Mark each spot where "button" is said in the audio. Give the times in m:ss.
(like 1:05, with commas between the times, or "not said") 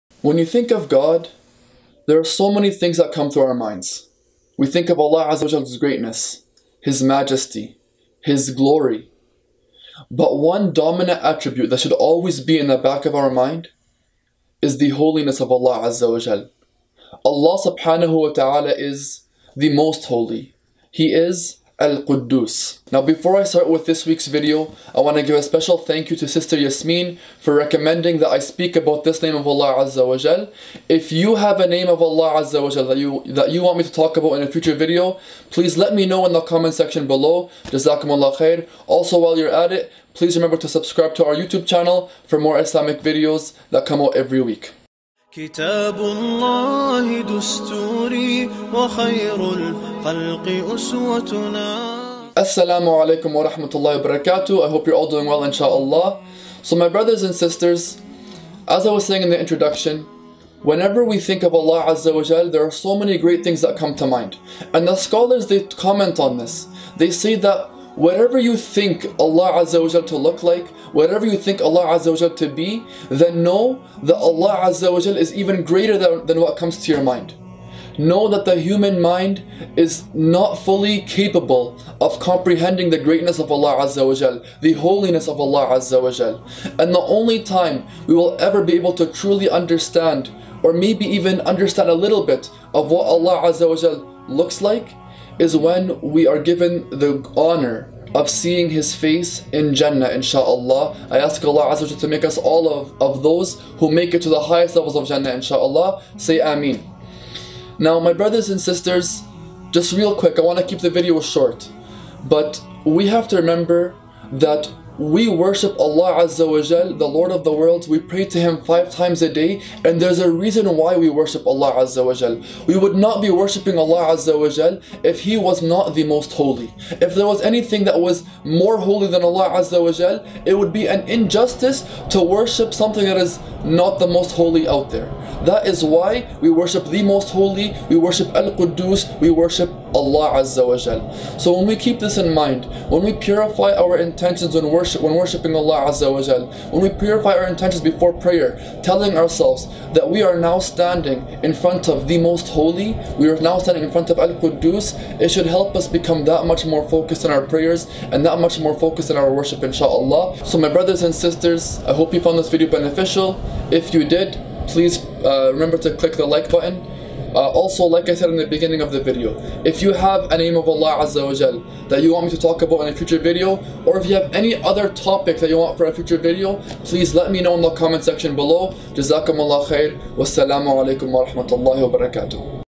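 2:46.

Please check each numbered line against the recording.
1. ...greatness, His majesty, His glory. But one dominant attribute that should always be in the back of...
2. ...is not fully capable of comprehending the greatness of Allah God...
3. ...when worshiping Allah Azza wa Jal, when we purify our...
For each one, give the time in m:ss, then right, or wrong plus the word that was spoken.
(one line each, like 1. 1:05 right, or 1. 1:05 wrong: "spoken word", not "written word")
1. 0:05 right
2. 1:19 wrong: "Azza", not "God"
3. 2:25 right.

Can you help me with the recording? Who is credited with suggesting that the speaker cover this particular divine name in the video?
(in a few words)
Sister Yasmin.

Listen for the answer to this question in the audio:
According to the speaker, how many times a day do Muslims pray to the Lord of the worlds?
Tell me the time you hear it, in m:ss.
1:58.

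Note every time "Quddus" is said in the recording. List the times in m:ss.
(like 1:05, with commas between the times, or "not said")
0:21, 2:18, 2:34.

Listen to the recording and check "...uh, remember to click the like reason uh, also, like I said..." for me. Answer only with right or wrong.
wrong.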